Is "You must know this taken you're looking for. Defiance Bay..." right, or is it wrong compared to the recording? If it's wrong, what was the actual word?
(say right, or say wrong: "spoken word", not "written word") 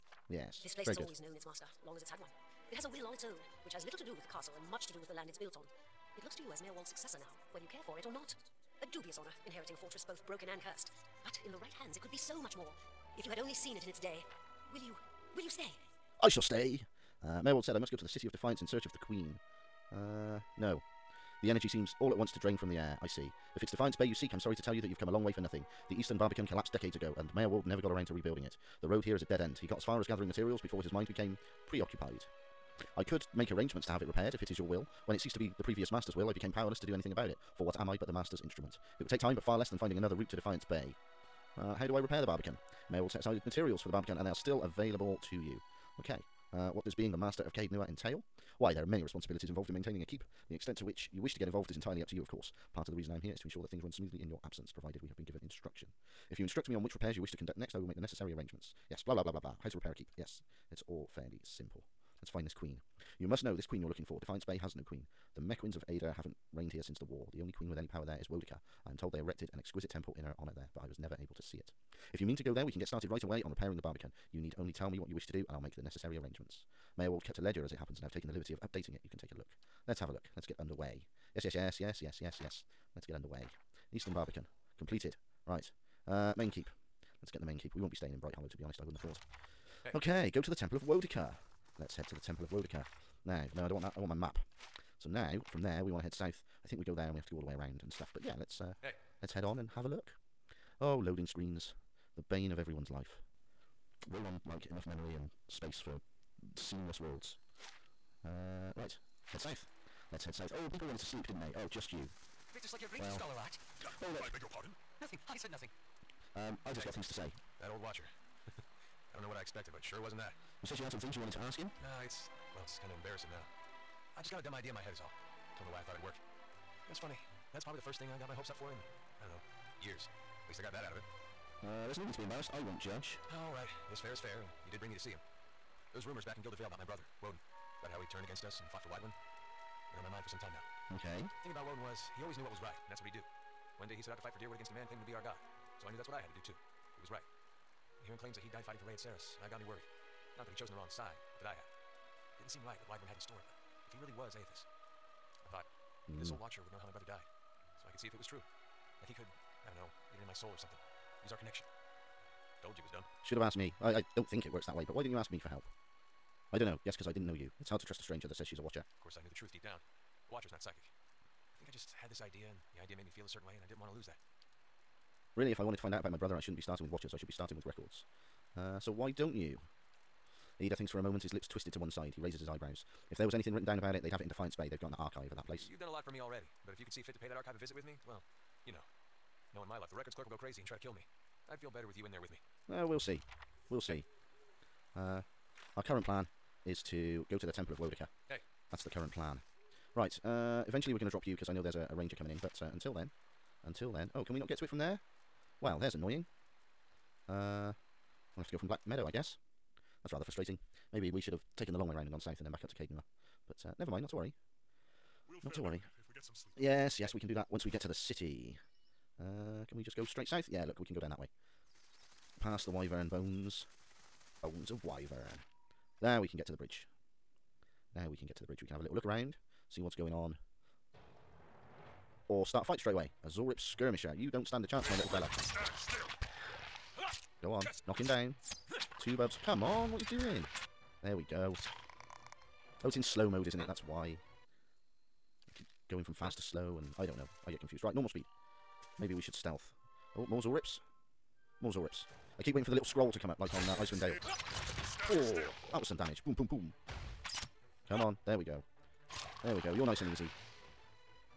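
wrong: "queen", not "taken".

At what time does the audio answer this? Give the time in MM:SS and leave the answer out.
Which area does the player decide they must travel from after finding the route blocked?
03:28.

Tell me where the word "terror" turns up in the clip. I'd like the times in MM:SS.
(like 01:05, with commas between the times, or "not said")
not said.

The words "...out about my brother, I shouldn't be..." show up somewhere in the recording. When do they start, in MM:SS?
02:55.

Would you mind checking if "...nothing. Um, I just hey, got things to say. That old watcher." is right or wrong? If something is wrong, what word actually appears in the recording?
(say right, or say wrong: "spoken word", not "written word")
right.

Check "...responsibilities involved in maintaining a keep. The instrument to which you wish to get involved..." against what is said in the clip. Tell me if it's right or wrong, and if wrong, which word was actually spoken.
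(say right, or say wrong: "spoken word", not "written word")
wrong: "extent", not "instrument".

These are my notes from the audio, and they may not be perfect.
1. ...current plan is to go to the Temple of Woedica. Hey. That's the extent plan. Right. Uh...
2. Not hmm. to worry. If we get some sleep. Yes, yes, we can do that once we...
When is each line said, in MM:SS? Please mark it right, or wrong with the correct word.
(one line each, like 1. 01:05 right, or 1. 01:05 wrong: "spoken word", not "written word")
1. 03:15 wrong: "current", not "extent"
2. 03:35 right.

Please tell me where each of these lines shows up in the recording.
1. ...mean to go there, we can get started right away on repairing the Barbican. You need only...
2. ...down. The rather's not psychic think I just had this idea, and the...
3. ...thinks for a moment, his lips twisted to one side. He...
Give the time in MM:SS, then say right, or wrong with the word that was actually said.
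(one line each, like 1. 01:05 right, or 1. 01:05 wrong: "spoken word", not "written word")
1. 01:12 right
2. 02:49 wrong: "watcher", not "rather"
3. 03:00 right.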